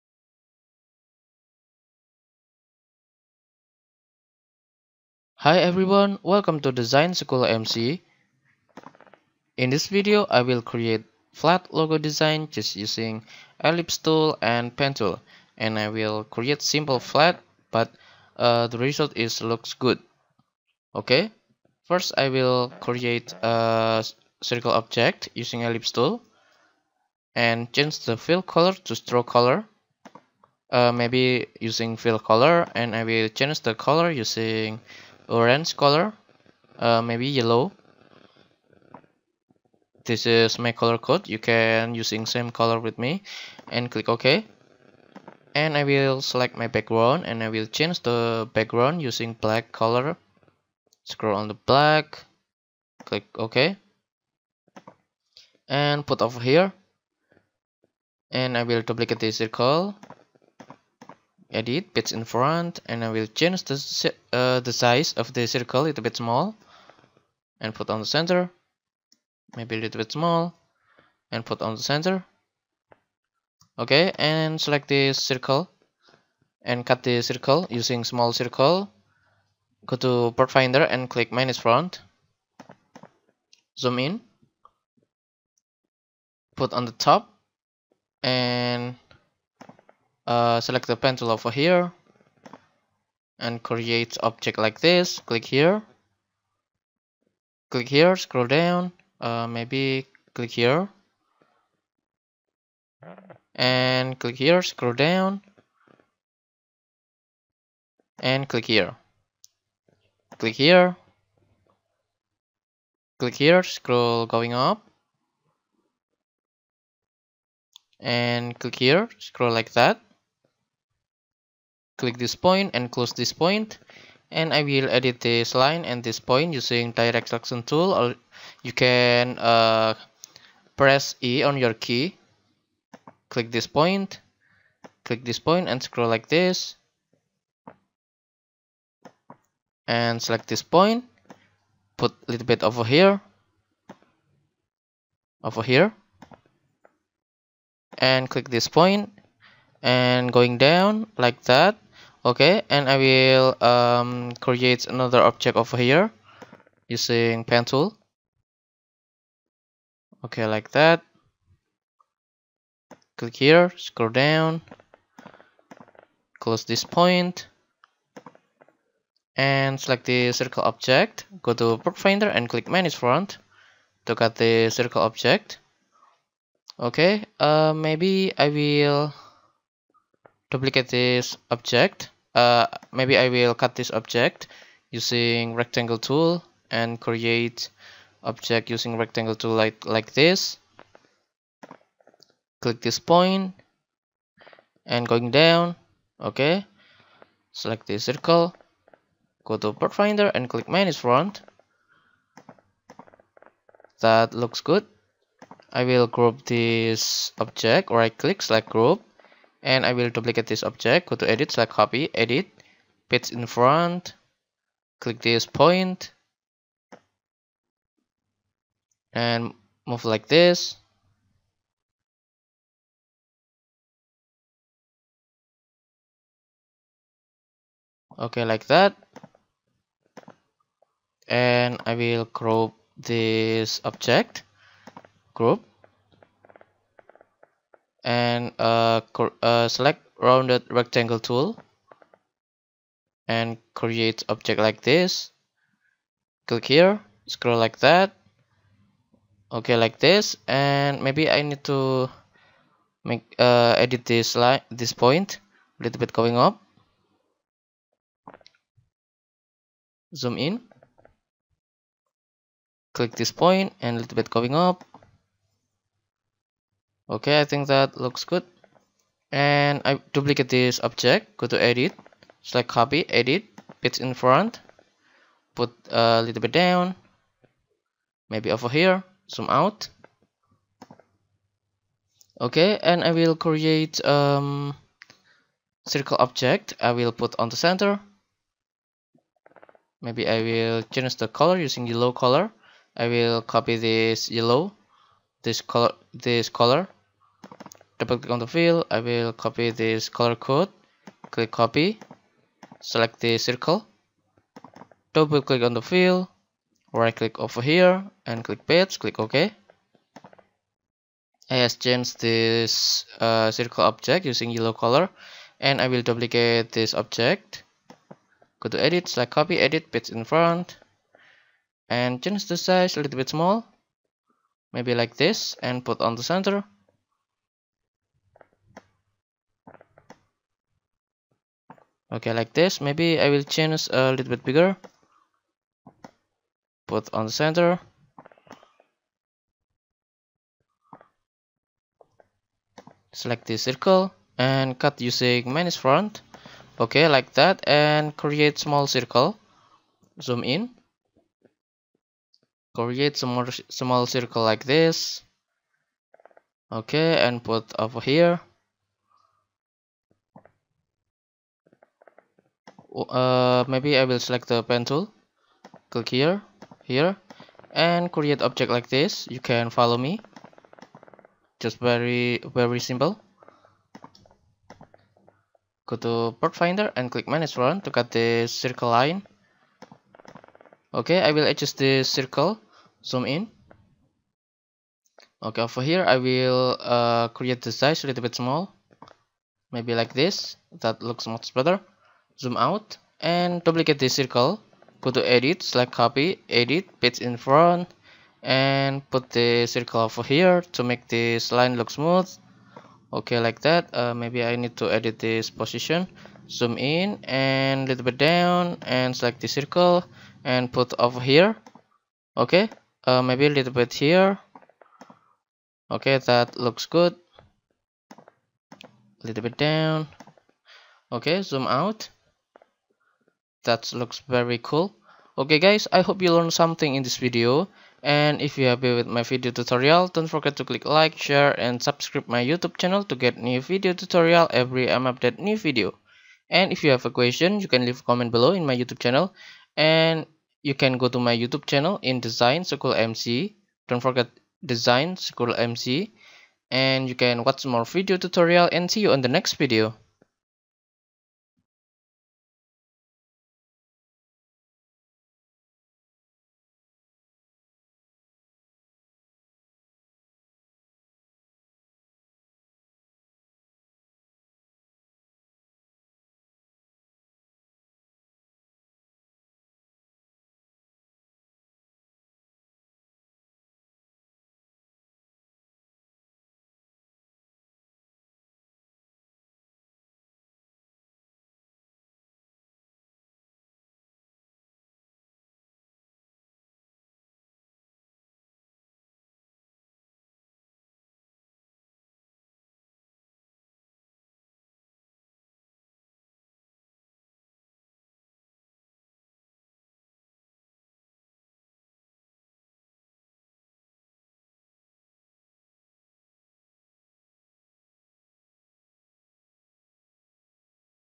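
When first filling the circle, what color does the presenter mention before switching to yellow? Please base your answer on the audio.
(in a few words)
orange.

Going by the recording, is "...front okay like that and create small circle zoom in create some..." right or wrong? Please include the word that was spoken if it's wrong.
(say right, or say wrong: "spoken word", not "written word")
right.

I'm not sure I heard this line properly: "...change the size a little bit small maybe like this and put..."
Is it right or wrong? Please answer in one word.
right.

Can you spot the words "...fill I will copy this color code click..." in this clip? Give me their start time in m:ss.
4:58.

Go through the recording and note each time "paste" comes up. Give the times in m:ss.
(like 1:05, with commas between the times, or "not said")
1:01, 3:33, 5:19, 6:36.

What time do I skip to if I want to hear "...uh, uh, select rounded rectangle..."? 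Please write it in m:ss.
3:58.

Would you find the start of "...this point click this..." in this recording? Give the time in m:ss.
2:13.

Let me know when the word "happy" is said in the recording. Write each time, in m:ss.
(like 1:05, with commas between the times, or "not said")
7:08.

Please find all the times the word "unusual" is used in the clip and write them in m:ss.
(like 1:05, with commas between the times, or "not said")
not said.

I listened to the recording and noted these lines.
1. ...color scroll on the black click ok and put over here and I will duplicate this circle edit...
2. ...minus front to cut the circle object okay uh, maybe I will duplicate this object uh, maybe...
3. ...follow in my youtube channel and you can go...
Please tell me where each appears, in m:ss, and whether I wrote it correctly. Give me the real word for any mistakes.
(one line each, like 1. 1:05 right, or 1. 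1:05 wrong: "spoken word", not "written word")
1. 0:49 right
2. 2:52 right
3. 7:18 wrong: "below", not "follow".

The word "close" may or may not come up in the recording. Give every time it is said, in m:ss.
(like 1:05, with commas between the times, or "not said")
2:02, 2:46.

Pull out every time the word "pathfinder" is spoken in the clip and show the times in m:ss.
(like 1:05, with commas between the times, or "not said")
1:20, 3:19, 6:16.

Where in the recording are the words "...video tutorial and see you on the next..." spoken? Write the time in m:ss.
7:27.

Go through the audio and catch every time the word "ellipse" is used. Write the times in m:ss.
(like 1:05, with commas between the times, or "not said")
0:13, 0:25.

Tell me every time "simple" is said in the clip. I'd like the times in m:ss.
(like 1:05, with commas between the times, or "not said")
0:16, 6:12.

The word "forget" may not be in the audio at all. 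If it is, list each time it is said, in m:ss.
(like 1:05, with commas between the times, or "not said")
7:10, 7:24.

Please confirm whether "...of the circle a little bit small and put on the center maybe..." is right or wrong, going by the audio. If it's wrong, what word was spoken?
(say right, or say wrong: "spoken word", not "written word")
right.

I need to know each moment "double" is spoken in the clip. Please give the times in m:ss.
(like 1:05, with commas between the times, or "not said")
4:58, 5:05.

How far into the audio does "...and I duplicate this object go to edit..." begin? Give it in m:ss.
4:29.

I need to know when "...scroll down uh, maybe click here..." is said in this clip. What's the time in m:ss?
1:38.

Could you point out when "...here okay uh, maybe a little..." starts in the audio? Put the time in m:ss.
6:51.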